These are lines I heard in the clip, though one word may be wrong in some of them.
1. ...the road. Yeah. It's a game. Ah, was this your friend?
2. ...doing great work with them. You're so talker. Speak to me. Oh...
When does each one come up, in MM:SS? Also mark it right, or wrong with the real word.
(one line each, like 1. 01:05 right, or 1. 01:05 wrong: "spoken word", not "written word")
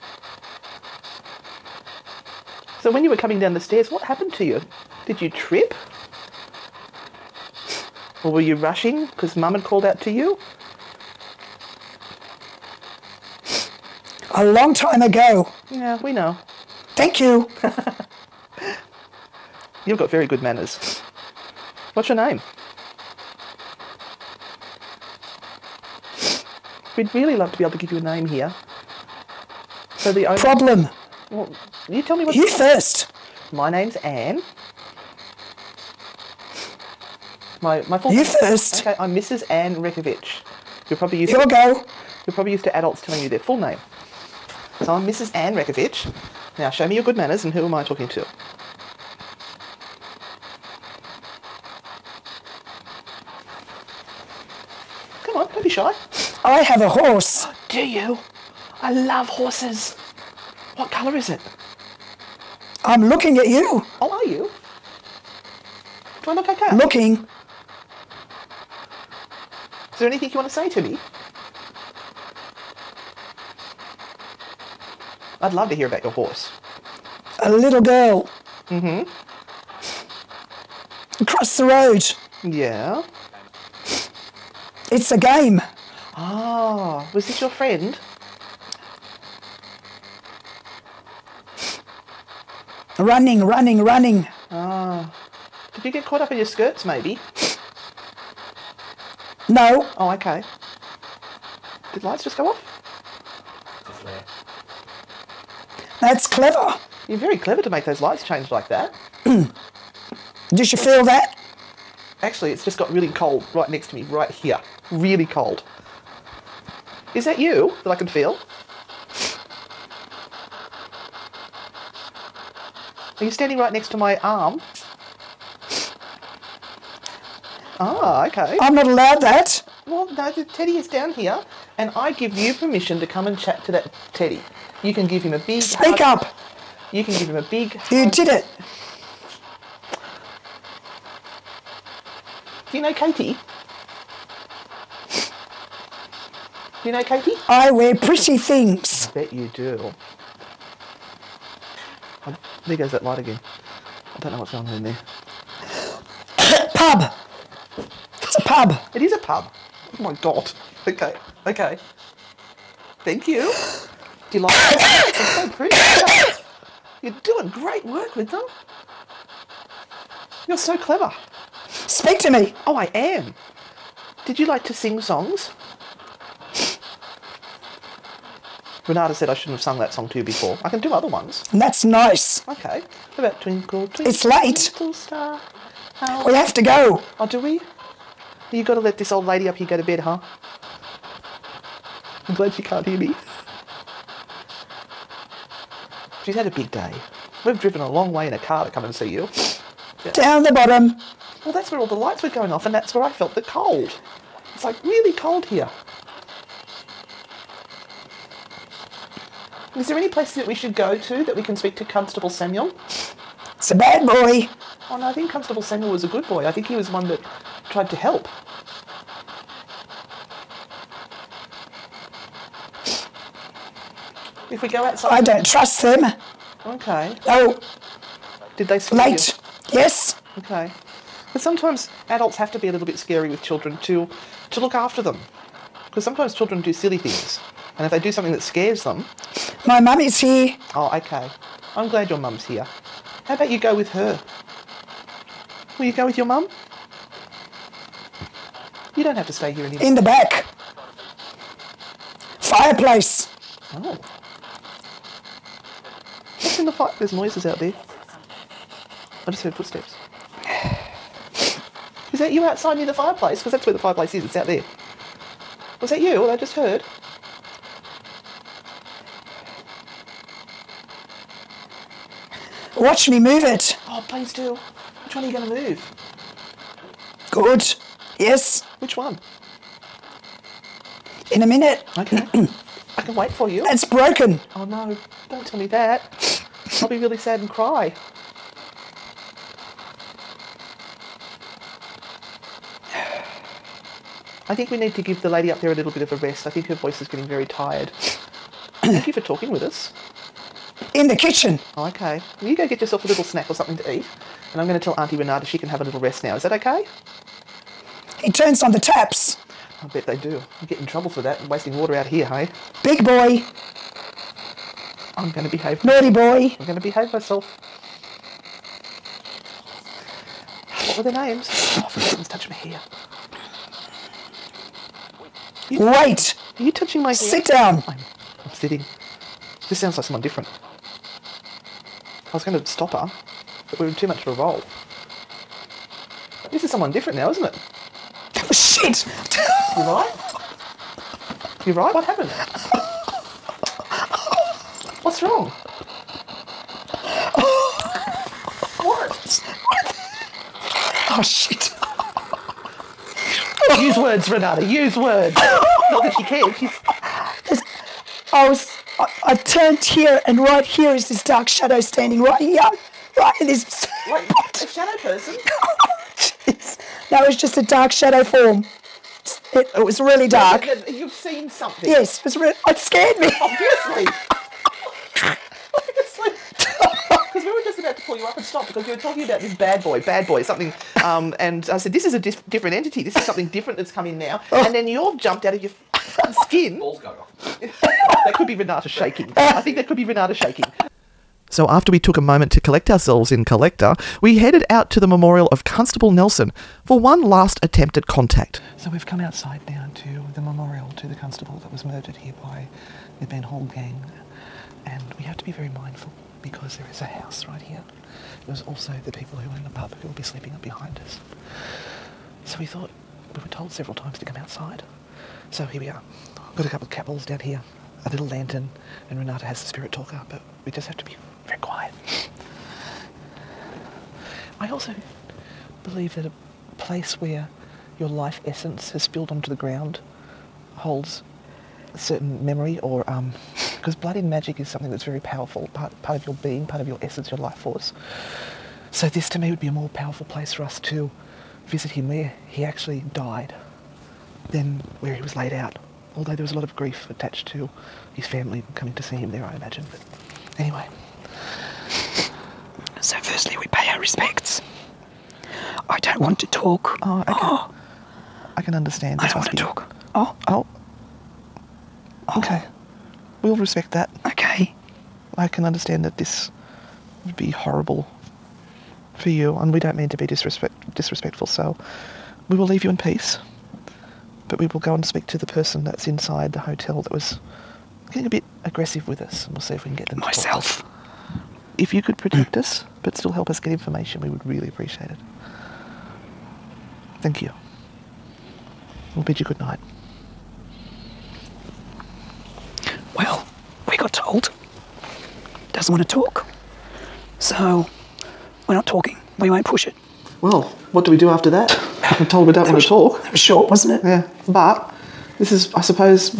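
1. 01:21 right
2. 02:47 wrong: "clever", not "talker".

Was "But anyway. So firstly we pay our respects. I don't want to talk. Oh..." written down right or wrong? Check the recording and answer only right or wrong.
right.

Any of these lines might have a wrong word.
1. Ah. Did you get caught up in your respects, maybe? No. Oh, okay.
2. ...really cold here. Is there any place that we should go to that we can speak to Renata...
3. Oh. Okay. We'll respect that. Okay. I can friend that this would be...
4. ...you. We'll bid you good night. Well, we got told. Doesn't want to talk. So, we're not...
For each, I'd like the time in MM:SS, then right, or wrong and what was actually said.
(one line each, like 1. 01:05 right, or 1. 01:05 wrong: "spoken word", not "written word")
1. 01:34 wrong: "skirts", not "respects"
2. 03:24 wrong: "Constable", not "Renata"
3. 07:42 wrong: "understand", not "friend"
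4. 08:07 right.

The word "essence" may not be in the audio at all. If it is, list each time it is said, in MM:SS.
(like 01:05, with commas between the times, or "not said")
07:08, 07:17.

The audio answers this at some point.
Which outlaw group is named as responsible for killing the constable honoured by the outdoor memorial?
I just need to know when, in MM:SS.
06:43.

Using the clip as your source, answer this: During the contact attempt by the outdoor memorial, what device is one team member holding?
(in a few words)
The spirit talker.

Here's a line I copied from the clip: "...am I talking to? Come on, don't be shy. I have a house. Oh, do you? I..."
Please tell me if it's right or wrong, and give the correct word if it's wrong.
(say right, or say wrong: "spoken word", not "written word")
wrong: "horse", not "house".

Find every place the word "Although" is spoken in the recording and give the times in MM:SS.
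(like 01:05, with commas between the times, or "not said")
07:26.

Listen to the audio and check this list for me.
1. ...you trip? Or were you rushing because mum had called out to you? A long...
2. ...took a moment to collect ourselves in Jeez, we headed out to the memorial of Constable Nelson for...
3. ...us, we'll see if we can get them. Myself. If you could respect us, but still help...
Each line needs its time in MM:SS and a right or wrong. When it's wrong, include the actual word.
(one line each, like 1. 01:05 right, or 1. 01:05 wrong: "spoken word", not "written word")
1. 00:05 right
2. 06:31 wrong: "Collector", not "Jeez"
3. 07:59 wrong: "protect", not "respect".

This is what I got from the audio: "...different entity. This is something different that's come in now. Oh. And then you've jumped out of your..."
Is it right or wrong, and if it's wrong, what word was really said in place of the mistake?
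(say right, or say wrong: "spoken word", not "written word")
right.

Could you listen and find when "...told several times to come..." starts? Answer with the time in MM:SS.
06:53.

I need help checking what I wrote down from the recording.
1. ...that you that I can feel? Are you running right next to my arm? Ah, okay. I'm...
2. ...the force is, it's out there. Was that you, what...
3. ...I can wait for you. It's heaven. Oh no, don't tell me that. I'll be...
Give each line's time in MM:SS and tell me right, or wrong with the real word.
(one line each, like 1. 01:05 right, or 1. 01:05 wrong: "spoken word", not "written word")
1. 01:57 wrong: "standing", not "running"
2. 04:23 wrong: "fireplace", not "force"
3. 04:42 wrong: "broken", not "heaven".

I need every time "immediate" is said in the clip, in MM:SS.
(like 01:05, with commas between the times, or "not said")
not said.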